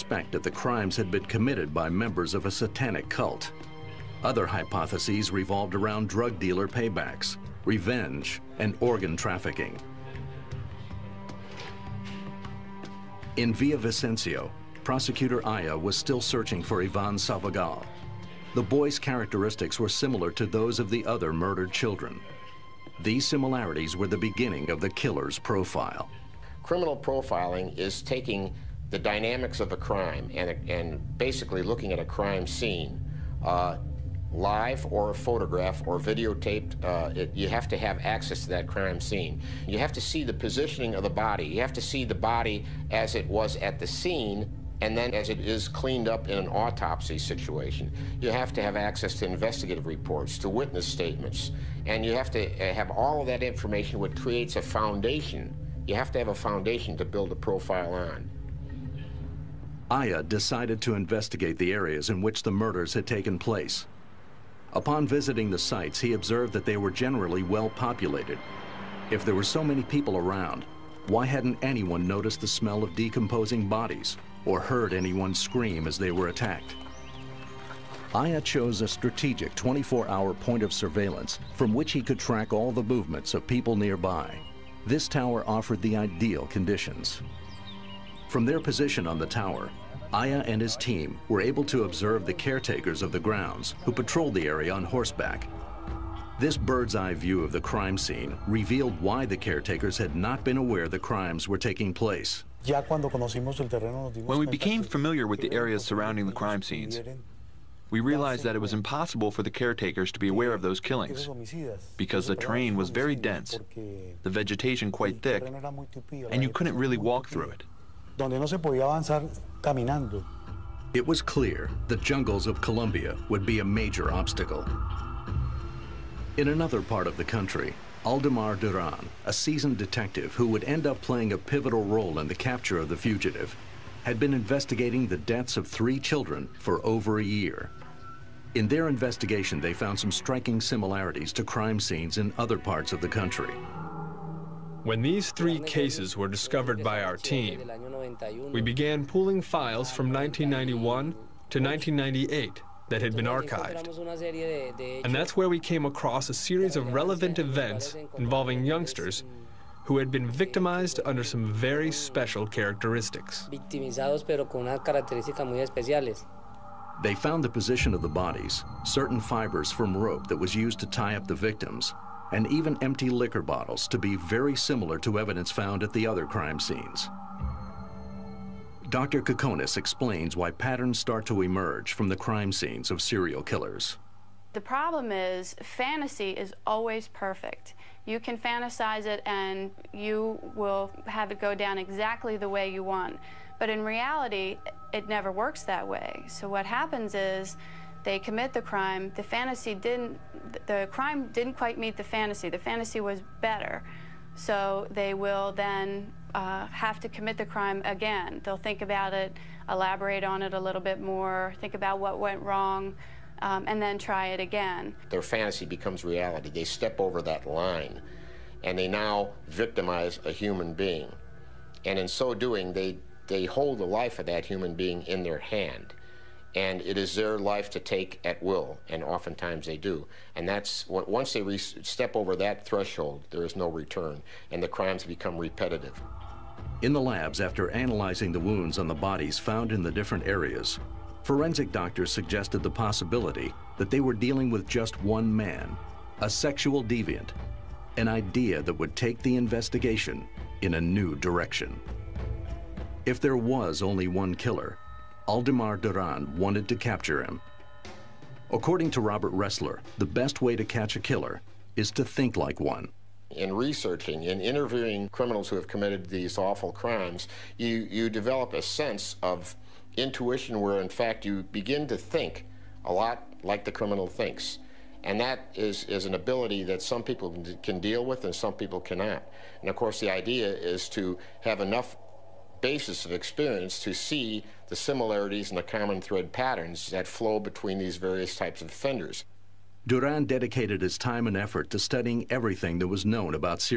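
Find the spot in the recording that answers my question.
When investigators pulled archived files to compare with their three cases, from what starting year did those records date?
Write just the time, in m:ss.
2:30.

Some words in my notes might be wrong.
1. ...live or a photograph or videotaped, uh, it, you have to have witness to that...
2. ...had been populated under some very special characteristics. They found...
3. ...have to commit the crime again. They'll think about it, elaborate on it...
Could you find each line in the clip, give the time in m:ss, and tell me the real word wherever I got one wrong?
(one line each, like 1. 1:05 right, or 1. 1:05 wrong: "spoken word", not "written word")
1. 0:34 wrong: "access", not "witness"
2. 2:39 wrong: "victimized", not "populated"
3. 3:26 right.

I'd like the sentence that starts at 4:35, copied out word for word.
And that is, is an ability that some people can deal with and some people cannot.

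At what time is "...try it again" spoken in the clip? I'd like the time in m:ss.
3:33.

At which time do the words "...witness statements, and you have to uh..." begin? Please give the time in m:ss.
0:50.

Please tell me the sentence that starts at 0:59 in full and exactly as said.
Aya decided to investigate the areas in which the murders had taken place.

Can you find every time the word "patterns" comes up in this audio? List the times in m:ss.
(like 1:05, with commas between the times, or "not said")
3:00, 4:46.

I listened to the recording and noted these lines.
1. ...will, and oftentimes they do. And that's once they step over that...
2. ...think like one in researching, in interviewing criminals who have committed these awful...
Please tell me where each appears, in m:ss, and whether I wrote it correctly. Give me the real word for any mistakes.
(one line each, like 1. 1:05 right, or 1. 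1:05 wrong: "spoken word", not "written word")
1. 3:48 right
2. 4:22 right.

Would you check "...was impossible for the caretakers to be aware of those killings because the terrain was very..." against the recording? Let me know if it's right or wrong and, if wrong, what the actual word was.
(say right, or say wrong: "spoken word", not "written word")
right.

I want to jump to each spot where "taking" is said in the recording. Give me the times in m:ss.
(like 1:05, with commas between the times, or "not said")
0:28, 1:41.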